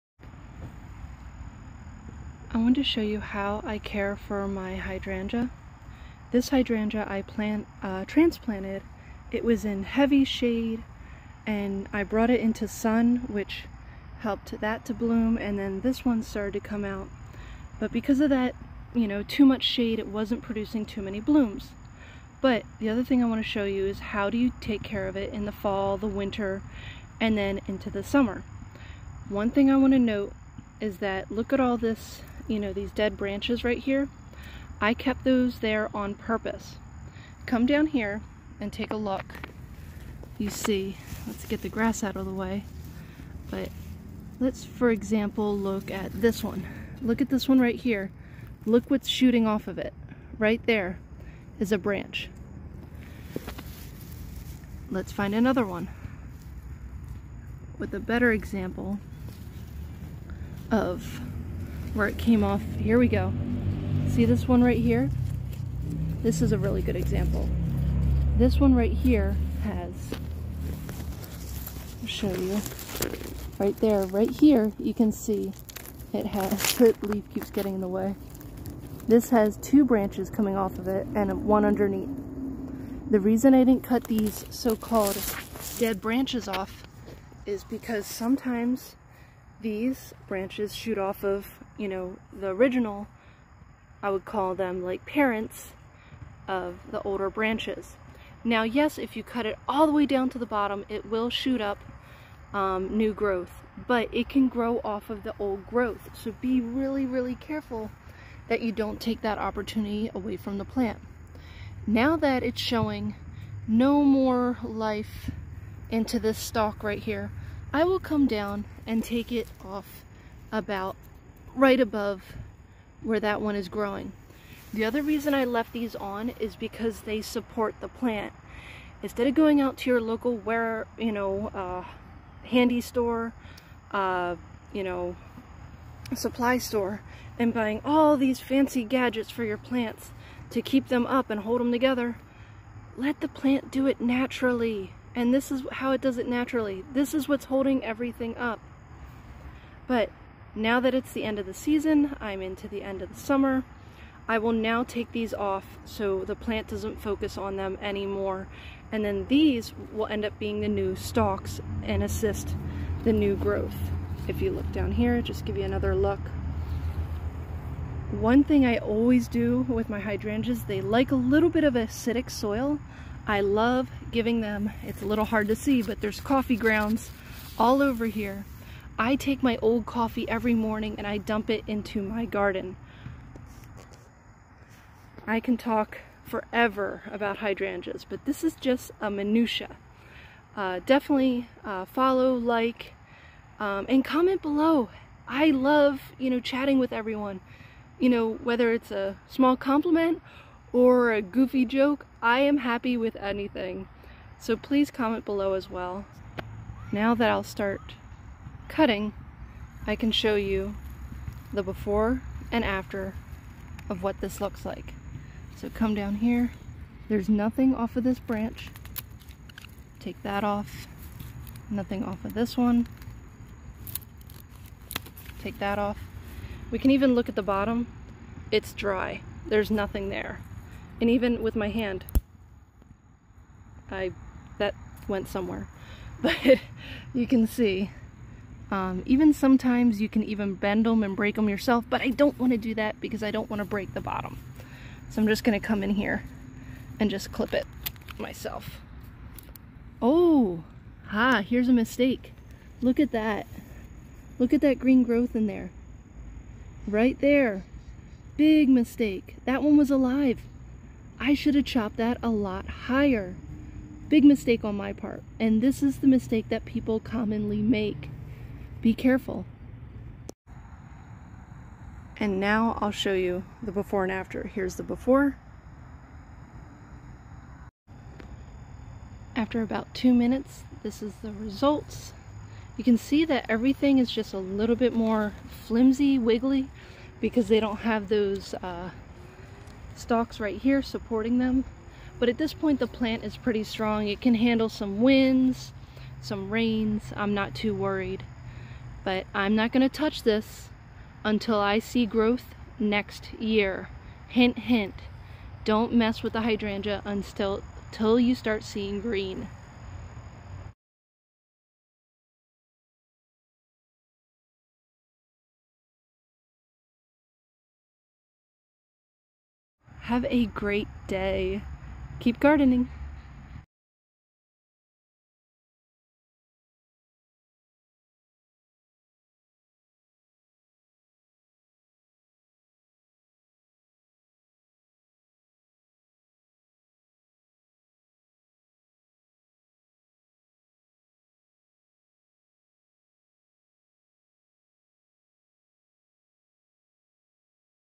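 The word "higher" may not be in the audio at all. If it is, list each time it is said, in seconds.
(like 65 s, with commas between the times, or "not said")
262 s.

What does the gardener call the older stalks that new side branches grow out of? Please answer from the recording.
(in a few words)
parents.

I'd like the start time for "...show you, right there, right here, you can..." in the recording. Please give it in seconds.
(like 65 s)
72 s.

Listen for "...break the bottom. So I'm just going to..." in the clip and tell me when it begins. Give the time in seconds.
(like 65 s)
243 s.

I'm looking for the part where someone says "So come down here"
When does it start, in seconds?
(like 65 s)
215 s.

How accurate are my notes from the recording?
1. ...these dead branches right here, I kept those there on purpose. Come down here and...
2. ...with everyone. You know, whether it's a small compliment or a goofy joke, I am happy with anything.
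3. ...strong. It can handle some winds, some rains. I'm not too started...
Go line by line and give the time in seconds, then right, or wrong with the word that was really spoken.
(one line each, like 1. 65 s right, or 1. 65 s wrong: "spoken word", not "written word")
1. 32 s right
2. 196 s right
3. 293 s wrong: "worried", not "started".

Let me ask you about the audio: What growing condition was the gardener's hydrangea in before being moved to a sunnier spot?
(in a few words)
heavy shade.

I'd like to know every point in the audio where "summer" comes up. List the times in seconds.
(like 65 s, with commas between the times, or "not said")
28 s, 153 s.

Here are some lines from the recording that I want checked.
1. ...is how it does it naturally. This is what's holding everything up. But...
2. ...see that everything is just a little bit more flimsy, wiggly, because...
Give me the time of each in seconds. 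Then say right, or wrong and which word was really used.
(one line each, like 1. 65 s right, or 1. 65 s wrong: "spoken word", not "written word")
1. 145 s right
2. 282 s right.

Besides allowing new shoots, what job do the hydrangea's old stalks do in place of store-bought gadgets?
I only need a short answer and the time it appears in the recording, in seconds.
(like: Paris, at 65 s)
support the plant, at 127 s.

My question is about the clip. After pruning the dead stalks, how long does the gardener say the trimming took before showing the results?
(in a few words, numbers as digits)
2 minutes.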